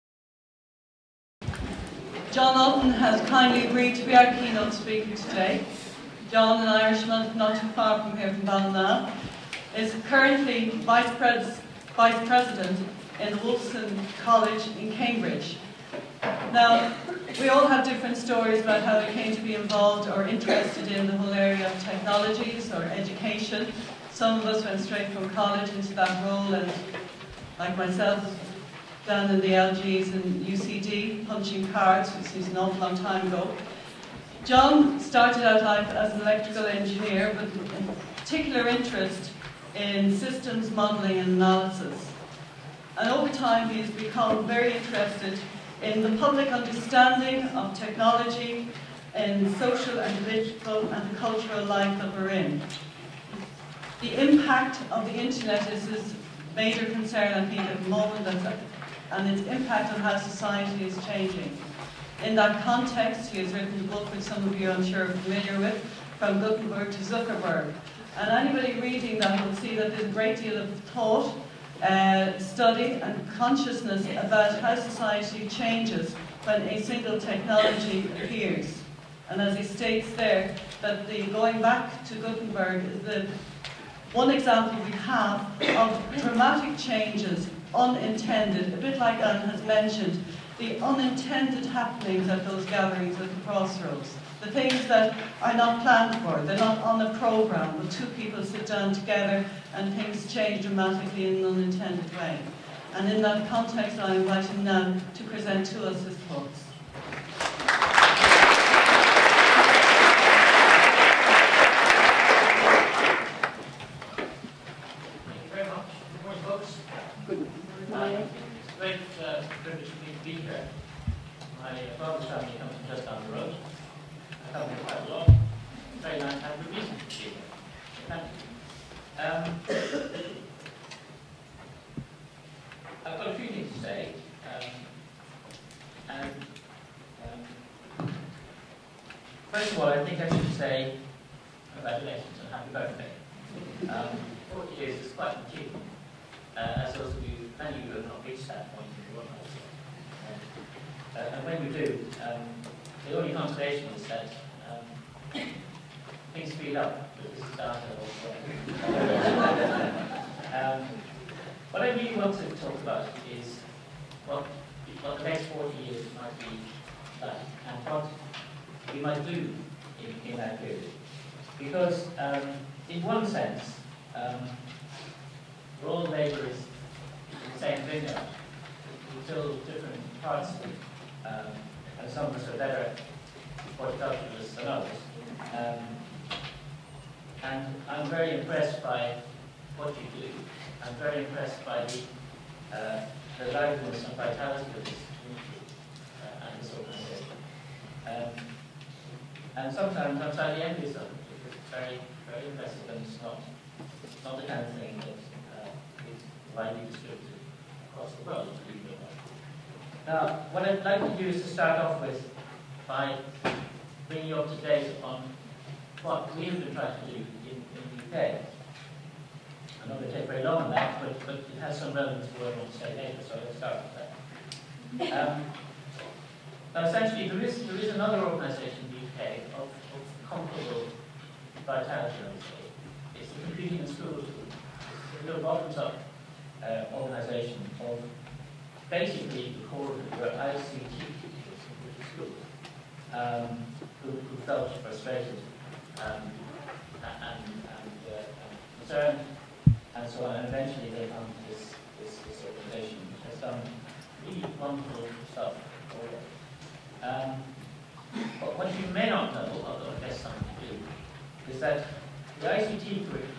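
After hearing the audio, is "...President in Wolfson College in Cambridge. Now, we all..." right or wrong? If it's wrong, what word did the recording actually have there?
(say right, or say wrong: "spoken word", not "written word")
right.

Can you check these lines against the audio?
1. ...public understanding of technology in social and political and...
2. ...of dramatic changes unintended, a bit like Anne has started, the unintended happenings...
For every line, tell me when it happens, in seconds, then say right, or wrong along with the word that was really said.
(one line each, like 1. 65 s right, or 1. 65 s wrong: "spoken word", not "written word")
1. 46 s right
2. 85 s wrong: "mentioned", not "started".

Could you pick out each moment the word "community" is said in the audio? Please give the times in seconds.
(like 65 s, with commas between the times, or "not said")
195 s.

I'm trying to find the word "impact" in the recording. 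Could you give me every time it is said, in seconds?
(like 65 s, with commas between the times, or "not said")
54 s, 59 s.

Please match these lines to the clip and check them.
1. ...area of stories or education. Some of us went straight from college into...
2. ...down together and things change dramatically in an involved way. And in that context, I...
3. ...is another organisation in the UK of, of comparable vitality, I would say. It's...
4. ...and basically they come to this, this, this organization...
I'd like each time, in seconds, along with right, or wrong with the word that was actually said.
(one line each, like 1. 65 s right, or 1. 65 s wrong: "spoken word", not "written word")
1. 21 s wrong: "technologies", not "stories"
2. 98 s wrong: "unintended", not "involved"
3. 227 s right
4. 250 s wrong: "eventually", not "basically".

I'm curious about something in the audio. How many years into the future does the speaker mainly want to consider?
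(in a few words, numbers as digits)
40.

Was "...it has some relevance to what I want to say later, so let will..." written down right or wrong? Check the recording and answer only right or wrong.
right.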